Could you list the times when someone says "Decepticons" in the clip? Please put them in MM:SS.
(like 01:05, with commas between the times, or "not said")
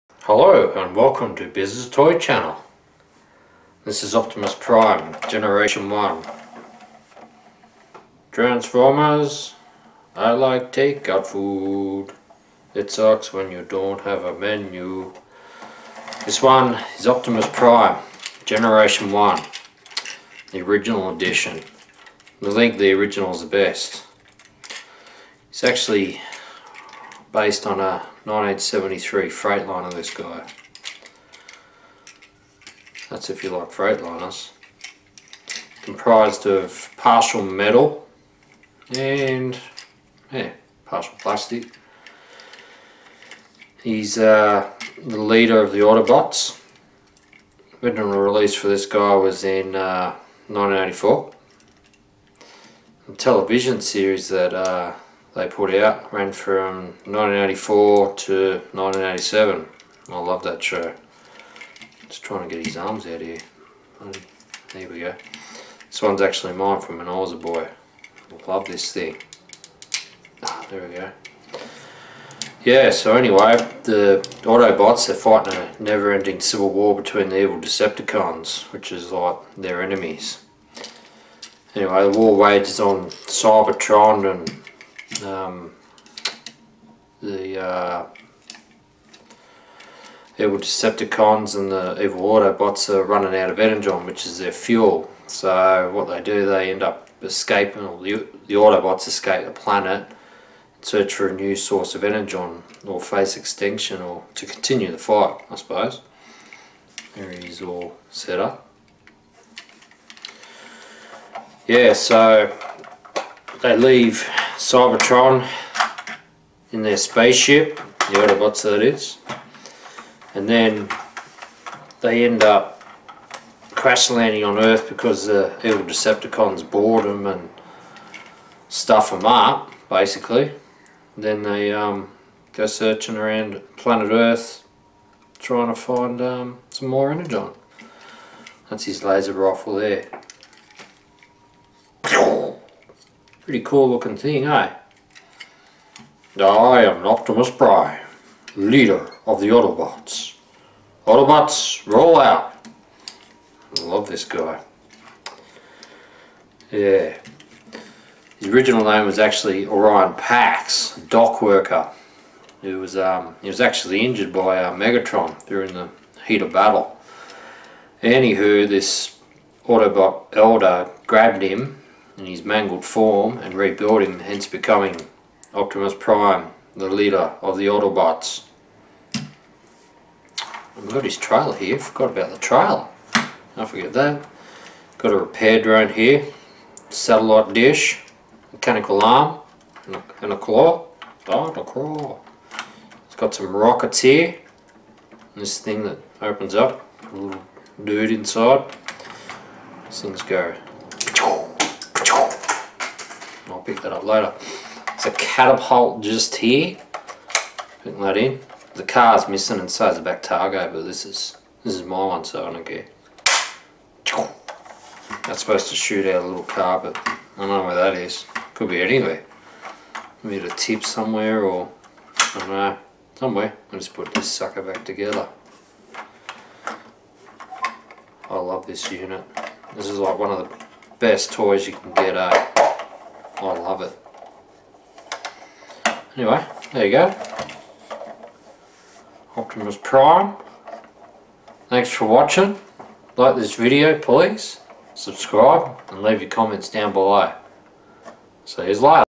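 01:17, 01:30, 02:05.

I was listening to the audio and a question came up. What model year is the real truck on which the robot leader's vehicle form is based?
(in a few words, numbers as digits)
1973.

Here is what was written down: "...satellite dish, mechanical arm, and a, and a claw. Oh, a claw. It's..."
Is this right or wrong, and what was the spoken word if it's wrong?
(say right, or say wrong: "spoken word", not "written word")
right.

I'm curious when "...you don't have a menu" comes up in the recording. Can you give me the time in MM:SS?
00:13.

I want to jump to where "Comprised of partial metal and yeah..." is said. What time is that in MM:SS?
00:35.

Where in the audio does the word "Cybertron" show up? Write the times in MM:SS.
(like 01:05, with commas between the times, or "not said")
01:23, 01:54.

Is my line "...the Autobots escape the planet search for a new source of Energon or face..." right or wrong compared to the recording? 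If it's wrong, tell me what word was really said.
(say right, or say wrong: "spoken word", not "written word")
right.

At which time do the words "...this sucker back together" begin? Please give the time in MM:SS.
03:44.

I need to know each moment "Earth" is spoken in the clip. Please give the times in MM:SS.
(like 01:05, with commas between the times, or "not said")
02:04, 02:14.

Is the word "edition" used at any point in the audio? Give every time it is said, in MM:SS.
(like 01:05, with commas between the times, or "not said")
00:21.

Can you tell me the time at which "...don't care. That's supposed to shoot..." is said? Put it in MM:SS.
03:32.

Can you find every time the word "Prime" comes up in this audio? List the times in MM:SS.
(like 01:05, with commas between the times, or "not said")
00:04, 00:17, 02:27, 02:55, 03:59.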